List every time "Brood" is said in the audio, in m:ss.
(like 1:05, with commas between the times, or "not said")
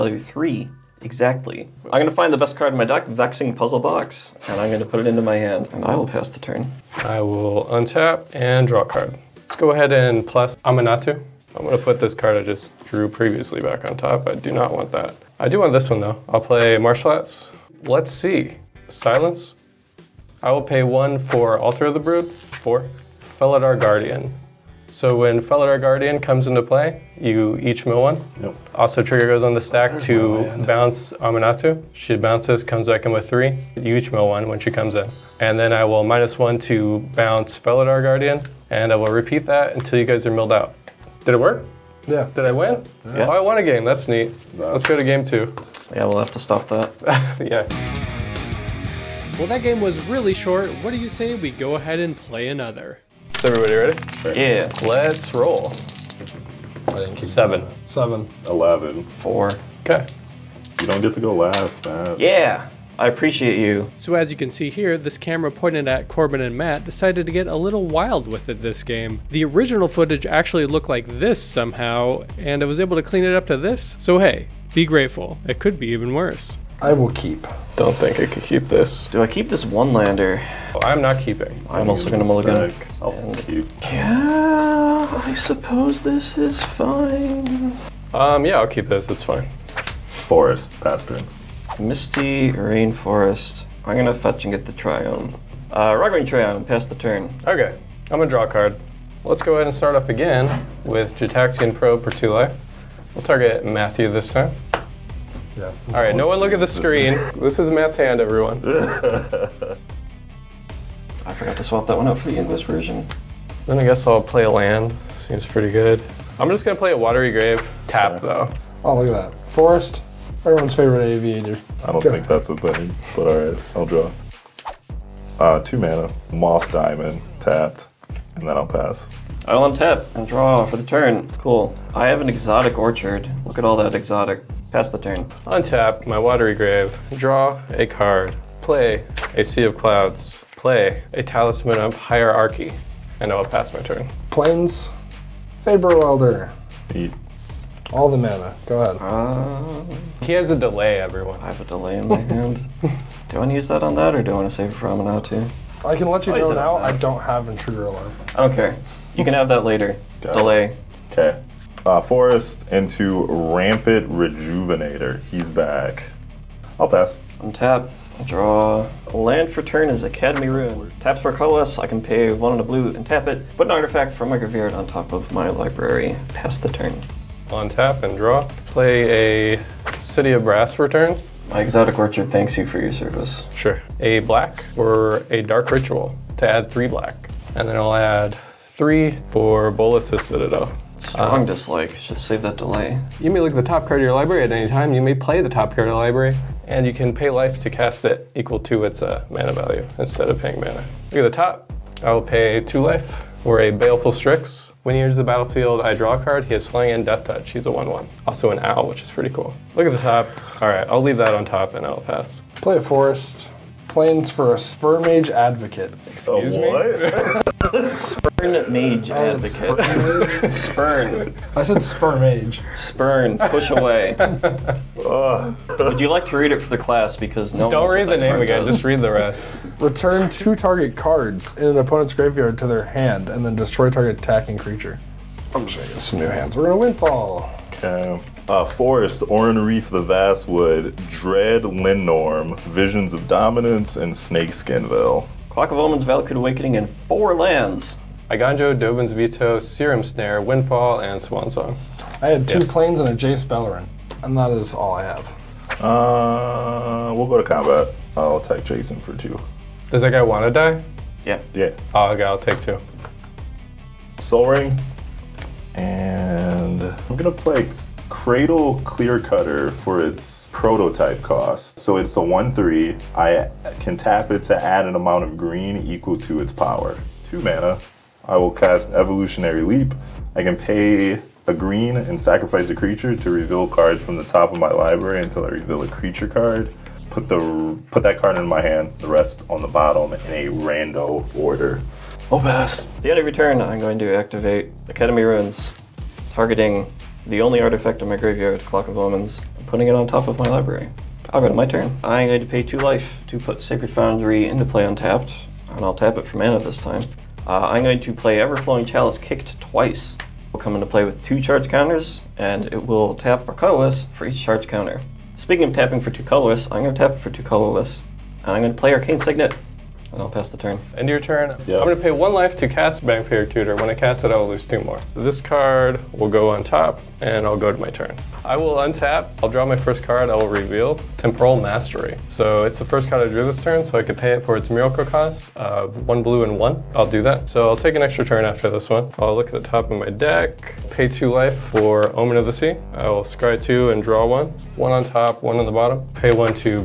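0:21.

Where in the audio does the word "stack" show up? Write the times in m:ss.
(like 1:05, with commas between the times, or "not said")
0:29.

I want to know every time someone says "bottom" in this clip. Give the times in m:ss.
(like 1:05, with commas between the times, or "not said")
4:49, 5:45.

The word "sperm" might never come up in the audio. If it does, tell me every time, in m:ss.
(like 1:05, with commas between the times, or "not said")
3:34, 3:41.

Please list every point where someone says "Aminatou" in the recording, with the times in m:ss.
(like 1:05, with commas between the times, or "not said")
0:10, 0:31.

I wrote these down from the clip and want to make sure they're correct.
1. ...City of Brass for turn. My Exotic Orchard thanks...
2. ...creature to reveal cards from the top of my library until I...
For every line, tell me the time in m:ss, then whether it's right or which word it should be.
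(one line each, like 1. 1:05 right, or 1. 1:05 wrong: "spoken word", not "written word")
1. 2:59 right
2. 4:42 right.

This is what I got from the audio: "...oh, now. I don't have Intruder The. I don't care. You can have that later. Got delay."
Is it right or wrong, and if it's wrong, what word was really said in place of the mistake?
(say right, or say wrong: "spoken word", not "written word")
wrong: "Alarm", not "The".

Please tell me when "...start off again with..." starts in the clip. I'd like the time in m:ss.
1:39.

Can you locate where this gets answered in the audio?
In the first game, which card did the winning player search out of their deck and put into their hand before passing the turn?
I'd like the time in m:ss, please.
0:03.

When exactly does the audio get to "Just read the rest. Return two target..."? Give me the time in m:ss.
3:48.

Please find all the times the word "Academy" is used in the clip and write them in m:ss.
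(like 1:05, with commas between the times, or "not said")
2:50, 4:54.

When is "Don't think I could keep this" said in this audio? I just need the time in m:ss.
1:17.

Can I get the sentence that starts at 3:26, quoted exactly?
He has Flying and Death Touch.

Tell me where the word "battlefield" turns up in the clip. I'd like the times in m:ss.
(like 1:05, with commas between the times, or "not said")
3:25.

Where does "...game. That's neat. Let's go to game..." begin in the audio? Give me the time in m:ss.
0:43.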